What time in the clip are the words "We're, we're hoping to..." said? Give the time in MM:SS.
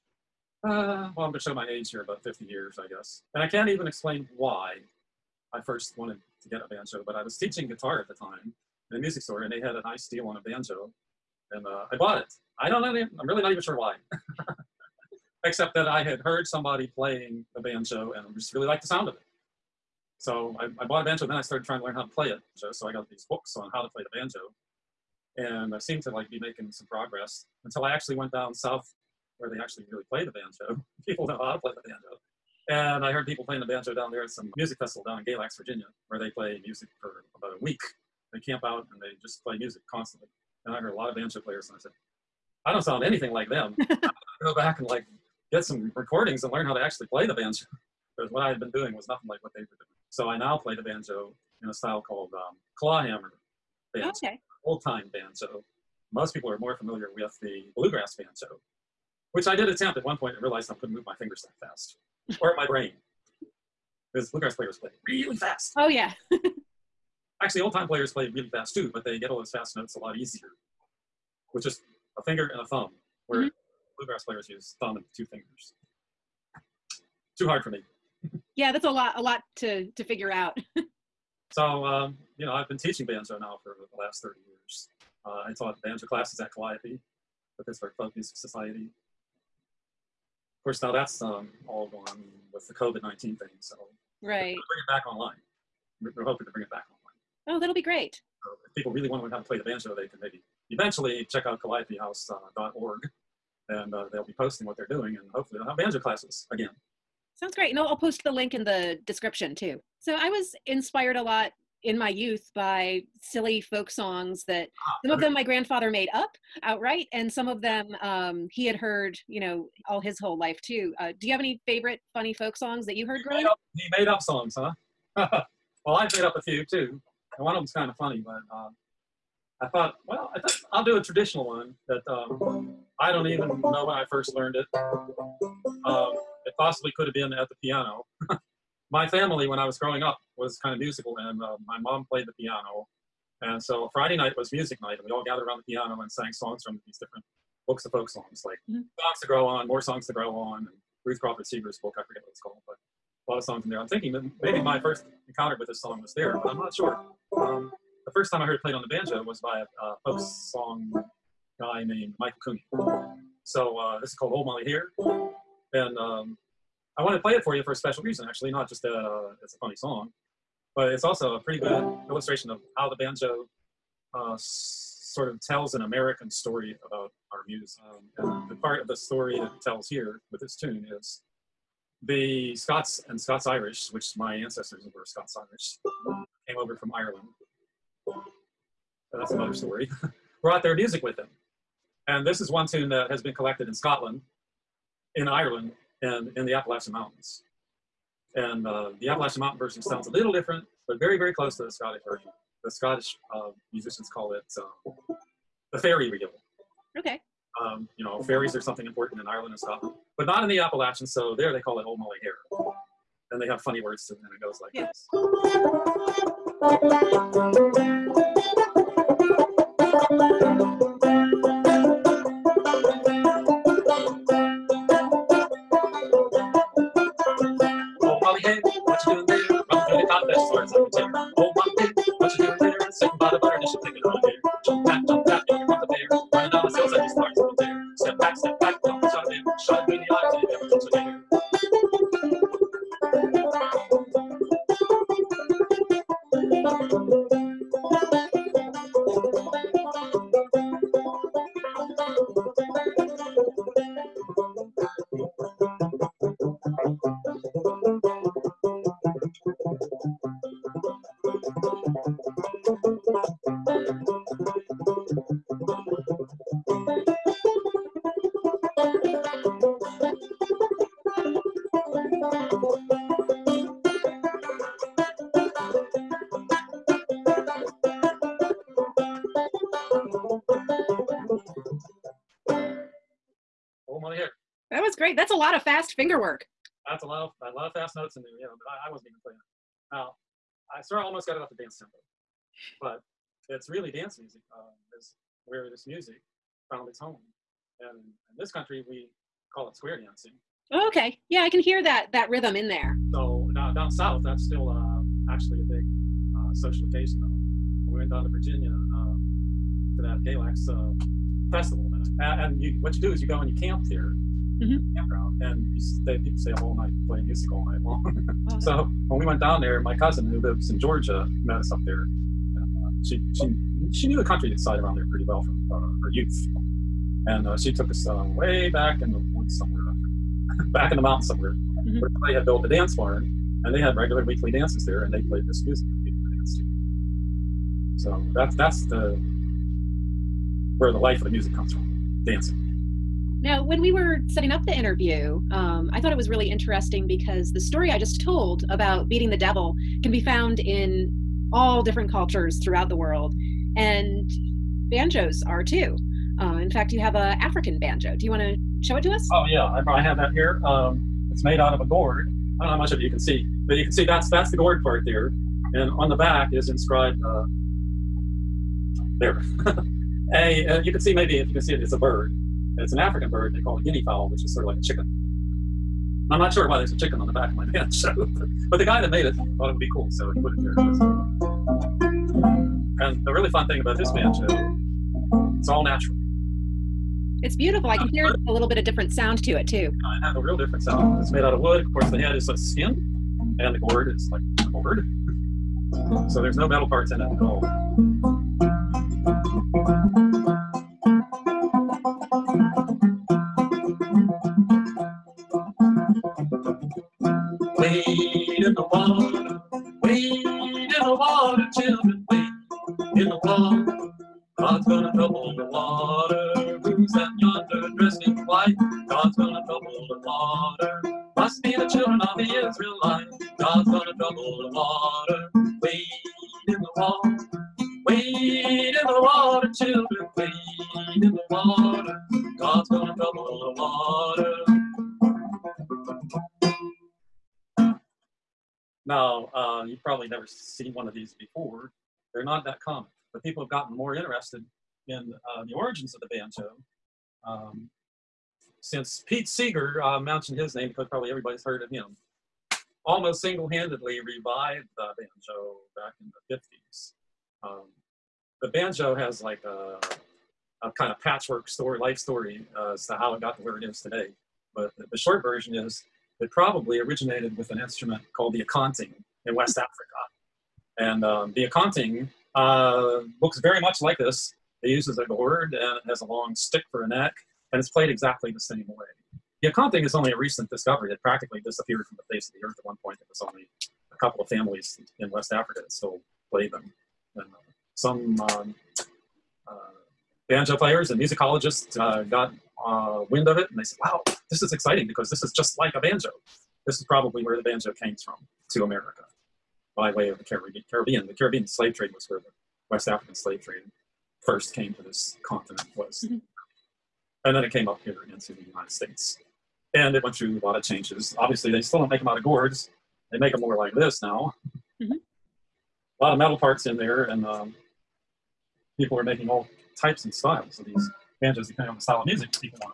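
01:36.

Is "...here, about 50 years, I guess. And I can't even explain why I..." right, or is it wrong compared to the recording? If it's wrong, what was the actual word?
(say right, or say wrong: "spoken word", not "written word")
right.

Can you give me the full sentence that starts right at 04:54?
Uh, is where this music found its home, and in this country we call it square dancing.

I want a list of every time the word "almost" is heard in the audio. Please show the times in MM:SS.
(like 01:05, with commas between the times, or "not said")
04:51, 07:33.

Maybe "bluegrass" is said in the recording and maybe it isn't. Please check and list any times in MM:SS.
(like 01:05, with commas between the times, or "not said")
00:57, 01:04, 01:13.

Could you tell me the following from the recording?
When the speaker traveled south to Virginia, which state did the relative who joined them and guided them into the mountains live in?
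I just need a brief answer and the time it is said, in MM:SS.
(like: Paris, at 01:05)
Georgia, at 05:20.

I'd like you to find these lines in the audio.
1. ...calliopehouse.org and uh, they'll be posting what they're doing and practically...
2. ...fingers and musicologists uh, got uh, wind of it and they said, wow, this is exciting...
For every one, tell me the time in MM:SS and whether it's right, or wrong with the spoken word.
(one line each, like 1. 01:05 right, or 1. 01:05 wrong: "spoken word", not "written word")
1. 01:41 wrong: "hopefully", not "practically"
2. 08:10 wrong: "players", not "fingers".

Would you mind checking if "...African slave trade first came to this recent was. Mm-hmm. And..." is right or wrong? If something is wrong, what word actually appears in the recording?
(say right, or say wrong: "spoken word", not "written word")
wrong: "continent", not "recent".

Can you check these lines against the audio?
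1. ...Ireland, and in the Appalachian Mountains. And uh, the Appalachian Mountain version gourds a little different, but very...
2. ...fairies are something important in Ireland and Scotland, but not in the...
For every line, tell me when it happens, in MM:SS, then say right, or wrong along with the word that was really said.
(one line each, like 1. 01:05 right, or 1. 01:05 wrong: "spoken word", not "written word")
1. 03:15 wrong: "sounds", not "gourds"
2. 03:28 right.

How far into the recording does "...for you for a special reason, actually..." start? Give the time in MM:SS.
02:47.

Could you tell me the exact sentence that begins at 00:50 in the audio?
So I now play the banjo in a style called um, clawhammer banjo, okay.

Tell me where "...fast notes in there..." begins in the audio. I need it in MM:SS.
04:47.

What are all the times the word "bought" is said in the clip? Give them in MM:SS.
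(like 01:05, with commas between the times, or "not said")
00:11, 00:20.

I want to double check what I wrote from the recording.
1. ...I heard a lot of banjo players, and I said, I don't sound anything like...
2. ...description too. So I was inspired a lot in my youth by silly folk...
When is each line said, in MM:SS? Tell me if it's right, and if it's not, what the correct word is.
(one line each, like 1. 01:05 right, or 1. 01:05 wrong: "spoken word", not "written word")
1. 00:40 right
2. 01:49 right.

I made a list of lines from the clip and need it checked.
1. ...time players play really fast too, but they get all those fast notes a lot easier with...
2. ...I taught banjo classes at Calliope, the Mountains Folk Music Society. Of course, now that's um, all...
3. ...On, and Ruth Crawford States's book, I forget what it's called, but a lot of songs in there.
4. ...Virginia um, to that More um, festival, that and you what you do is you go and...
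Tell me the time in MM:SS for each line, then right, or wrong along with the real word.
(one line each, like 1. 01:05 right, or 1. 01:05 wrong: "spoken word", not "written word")
1. 01:07 right
2. 01:25 wrong: "Pittsburgh", not "Mountains"
3. 02:30 wrong: "Seeger", not "States"
4. 05:08 wrong: "Galax", not "More".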